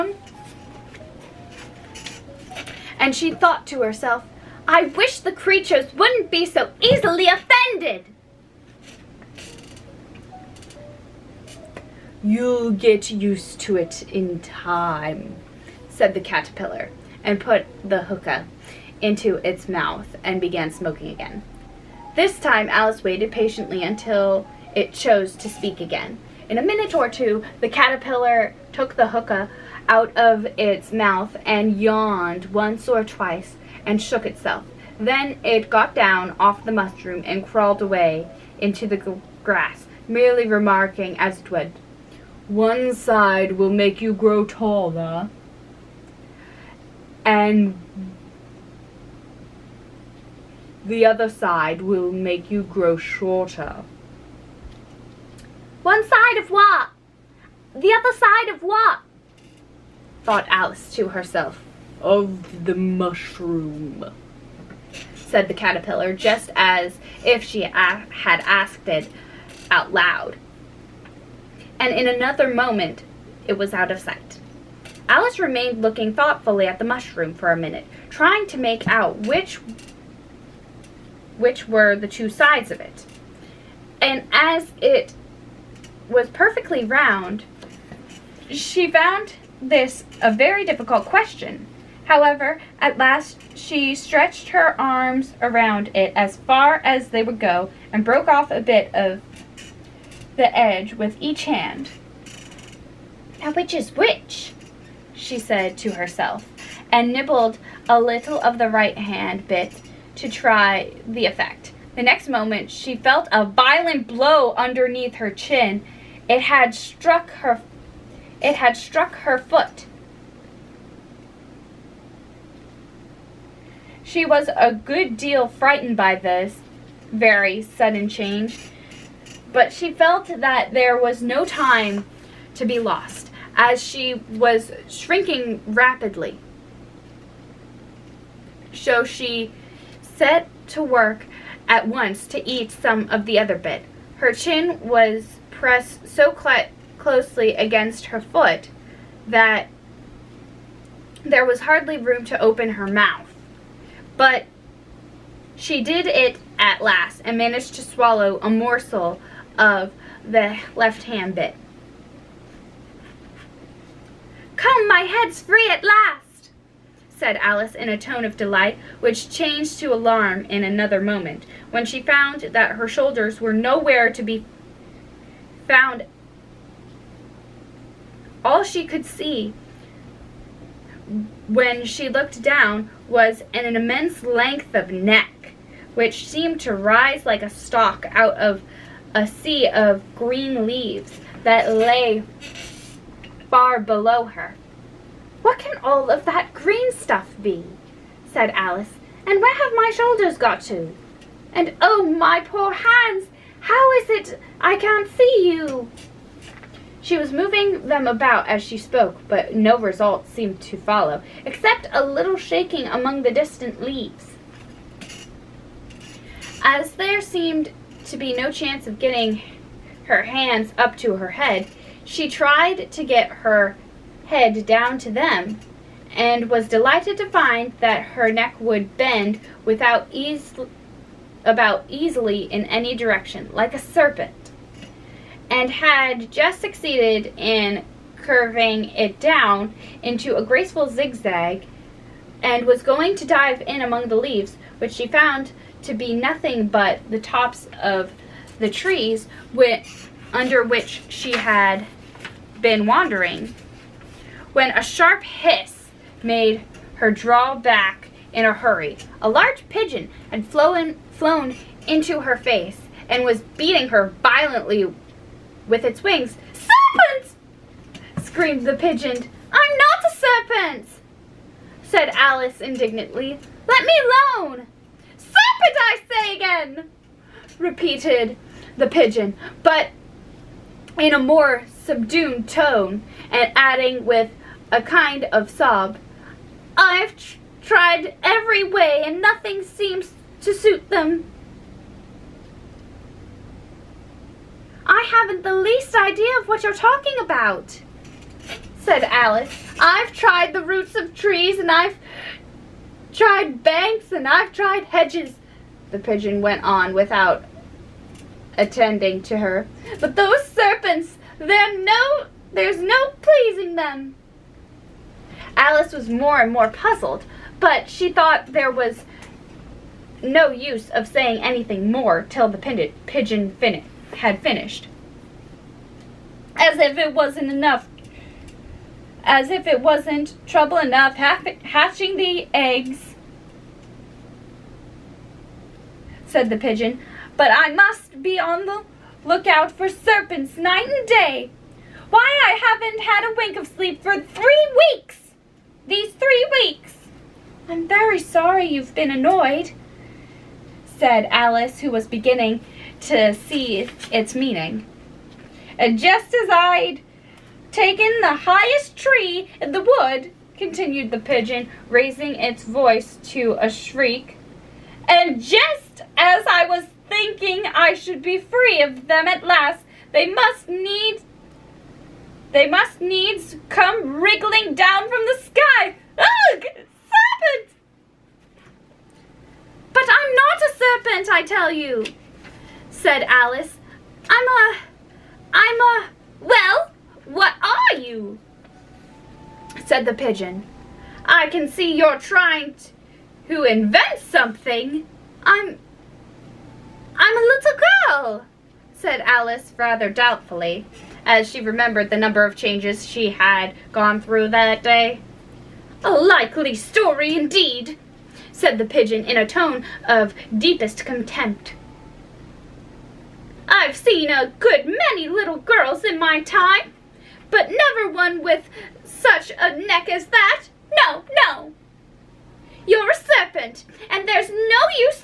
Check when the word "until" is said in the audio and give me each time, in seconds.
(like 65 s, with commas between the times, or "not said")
23 s.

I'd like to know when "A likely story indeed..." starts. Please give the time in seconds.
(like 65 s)
406 s.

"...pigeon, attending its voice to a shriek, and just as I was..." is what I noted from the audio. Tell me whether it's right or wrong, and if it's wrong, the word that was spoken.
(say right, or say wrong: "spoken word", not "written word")
wrong: "raising", not "attending".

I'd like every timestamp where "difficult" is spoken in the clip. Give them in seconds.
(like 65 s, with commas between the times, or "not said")
90 s.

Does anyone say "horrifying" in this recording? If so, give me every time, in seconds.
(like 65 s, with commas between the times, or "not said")
not said.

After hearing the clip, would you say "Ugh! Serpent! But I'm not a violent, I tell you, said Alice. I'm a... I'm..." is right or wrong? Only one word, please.
wrong.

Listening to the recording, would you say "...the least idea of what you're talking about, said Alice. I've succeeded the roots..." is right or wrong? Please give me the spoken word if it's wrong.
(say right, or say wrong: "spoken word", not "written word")
wrong: "tried", not "succeeded".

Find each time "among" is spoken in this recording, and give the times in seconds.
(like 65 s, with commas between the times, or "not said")
212 s, 243 s.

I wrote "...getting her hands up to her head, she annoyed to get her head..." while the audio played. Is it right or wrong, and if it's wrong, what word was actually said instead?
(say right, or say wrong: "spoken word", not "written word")
wrong: "tried", not "annoyed".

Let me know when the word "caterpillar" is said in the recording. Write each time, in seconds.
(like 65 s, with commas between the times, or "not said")
16 s, 27 s, 65 s.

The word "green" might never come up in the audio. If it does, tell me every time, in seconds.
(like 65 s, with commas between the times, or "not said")
190 s, 196 s.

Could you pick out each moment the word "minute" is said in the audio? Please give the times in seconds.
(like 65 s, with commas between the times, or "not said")
26 s, 77 s.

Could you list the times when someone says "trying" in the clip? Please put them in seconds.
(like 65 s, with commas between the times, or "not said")
78 s, 392 s.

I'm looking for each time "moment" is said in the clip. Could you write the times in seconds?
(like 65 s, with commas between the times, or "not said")
72 s, 112 s, 170 s.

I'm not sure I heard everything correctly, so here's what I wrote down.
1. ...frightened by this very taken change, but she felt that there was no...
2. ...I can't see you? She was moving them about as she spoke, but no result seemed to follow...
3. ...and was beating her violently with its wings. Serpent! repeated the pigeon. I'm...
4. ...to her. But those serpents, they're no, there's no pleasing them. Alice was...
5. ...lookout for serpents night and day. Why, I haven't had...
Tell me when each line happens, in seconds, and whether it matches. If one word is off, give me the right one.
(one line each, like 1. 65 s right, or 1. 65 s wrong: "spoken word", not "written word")
1. 125 s wrong: "sudden", not "taken"
2. 204 s right
3. 263 s wrong: "screamed", not "repeated"
4. 309 s right
5. 339 s right.